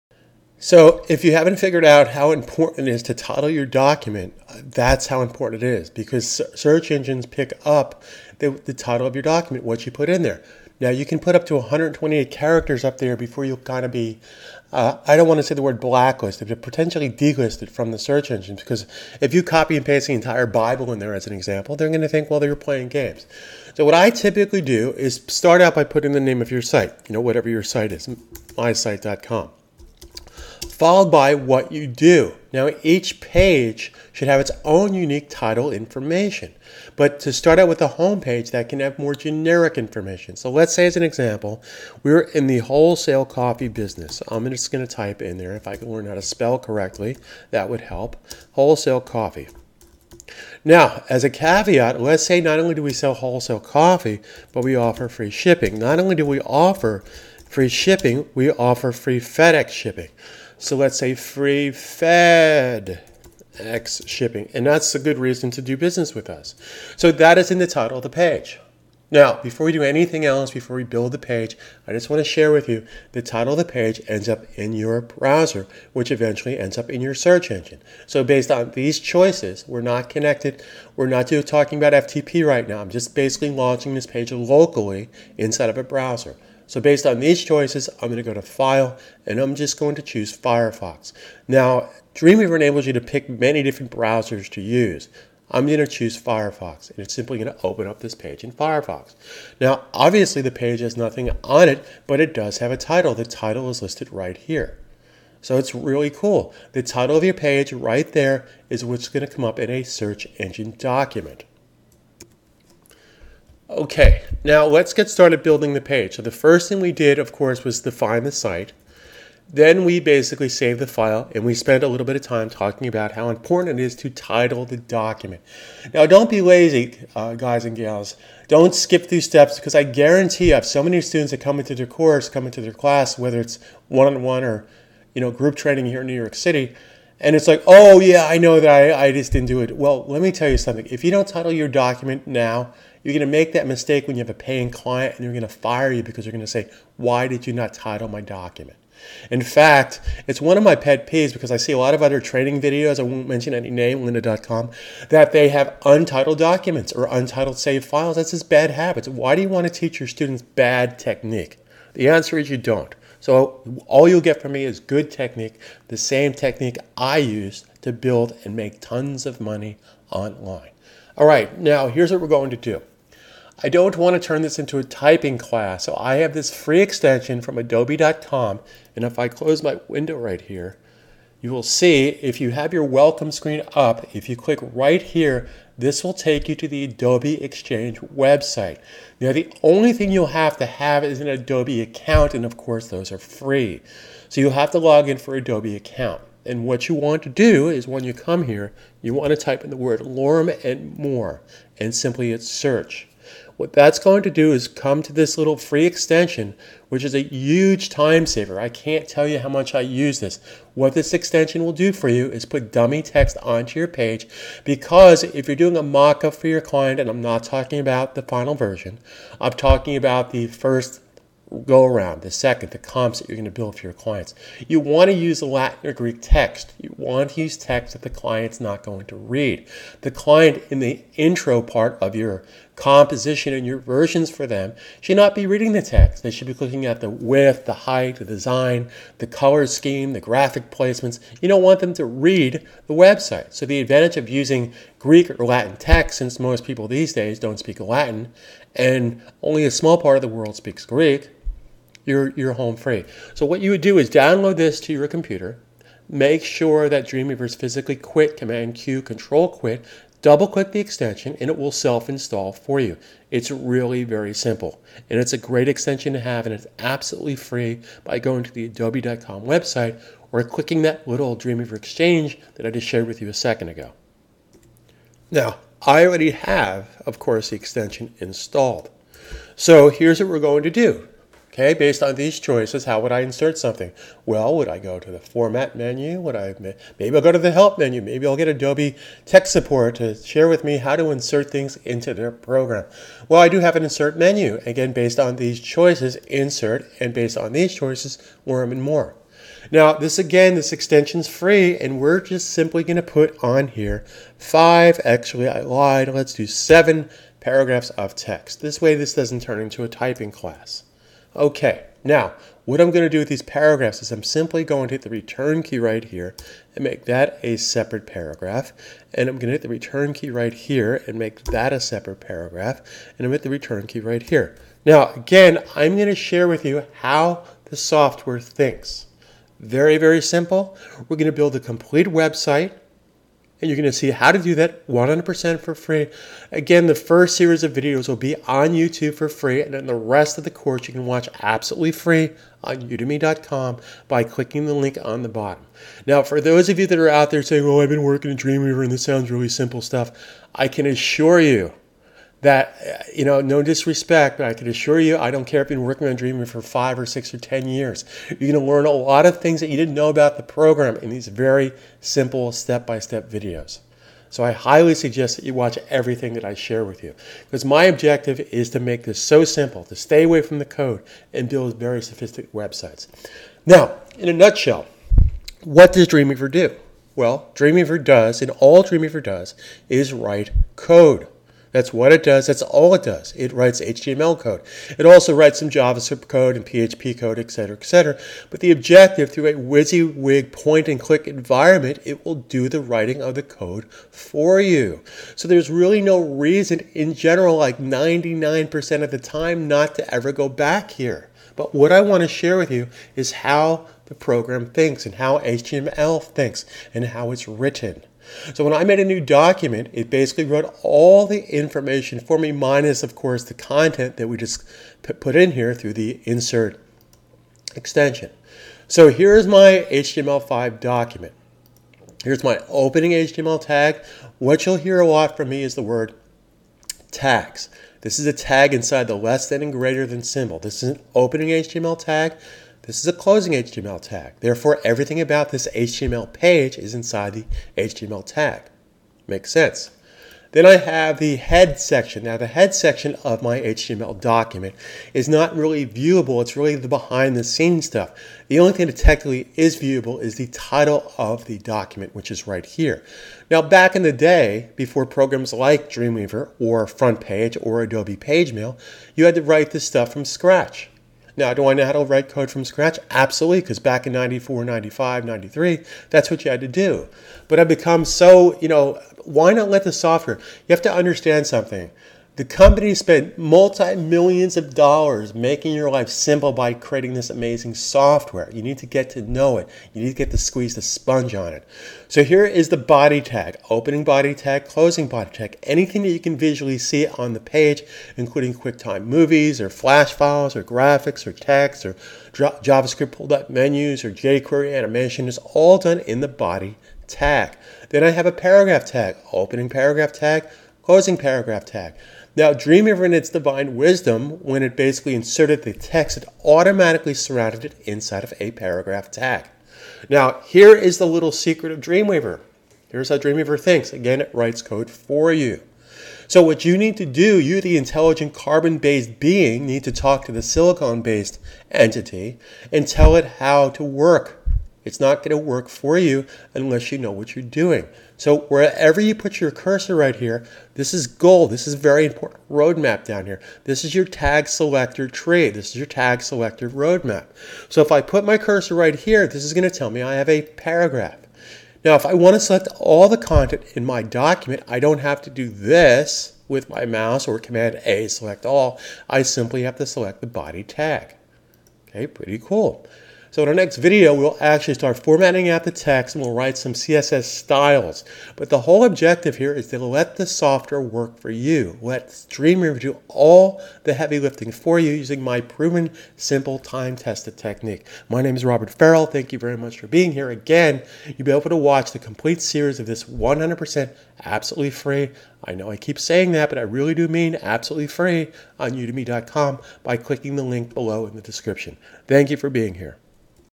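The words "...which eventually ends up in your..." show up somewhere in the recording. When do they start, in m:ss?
1:15.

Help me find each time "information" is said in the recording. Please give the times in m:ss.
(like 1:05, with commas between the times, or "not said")
0:35, 0:39, 6:51.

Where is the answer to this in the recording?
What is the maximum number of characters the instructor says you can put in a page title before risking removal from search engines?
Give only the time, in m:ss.
0:11.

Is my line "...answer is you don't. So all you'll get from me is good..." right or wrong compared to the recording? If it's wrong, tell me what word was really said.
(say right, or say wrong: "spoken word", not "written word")
right.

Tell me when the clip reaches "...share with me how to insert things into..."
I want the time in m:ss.
4:50.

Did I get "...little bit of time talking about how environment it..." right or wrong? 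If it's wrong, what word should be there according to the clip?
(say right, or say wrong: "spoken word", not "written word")
wrong: "important", not "environment".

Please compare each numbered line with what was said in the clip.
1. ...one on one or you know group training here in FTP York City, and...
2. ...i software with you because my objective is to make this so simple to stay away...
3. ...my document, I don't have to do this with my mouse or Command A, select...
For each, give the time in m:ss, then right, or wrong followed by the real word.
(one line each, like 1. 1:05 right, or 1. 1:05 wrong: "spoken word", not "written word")
1. 2:13 wrong: "New", not "FTP"
2. 6:06 wrong: "share", not "software"
3. 9:03 right.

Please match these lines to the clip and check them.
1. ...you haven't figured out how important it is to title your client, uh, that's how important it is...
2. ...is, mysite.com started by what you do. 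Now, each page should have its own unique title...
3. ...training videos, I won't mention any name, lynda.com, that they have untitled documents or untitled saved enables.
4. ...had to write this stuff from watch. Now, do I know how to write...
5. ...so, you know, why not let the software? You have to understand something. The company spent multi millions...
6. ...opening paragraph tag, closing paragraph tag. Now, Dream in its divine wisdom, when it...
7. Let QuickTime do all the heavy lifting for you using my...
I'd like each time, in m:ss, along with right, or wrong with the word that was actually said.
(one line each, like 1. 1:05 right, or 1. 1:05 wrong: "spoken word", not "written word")
1. 0:01 wrong: "document", not "client"
2. 0:27 wrong: "followed", not "started"
3. 2:32 wrong: "files", not "enables"
4. 7:39 wrong: "scratch", not "watch"
5. 7:48 right
6. 8:19 right
7. 9:21 wrong: "Dreamweaver", not "QuickTime".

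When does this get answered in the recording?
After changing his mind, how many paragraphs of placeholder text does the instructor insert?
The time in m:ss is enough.
5:06.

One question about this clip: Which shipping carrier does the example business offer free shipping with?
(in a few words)
FedEx.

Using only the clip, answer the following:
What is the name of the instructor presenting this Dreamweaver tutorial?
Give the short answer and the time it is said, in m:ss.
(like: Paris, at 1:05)
Robert Farrell, at 9:28.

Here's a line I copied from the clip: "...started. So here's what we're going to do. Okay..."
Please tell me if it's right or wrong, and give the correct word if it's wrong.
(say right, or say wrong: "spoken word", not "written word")
wrong: "installed", not "started".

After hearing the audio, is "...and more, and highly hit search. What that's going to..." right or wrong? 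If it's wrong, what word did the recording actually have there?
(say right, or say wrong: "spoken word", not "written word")
wrong: "simply", not "highly".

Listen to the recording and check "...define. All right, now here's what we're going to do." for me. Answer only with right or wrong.
wrong.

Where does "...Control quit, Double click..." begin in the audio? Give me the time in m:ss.
4:19.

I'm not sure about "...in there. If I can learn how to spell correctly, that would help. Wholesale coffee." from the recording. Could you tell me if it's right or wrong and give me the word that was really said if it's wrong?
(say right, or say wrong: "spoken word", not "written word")
right.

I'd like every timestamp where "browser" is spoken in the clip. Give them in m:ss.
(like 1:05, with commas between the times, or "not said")
1:15, 1:25, 1:33.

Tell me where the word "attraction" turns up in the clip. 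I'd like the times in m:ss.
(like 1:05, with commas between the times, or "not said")
not said.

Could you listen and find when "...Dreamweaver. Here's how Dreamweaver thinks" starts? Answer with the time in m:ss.
8:31.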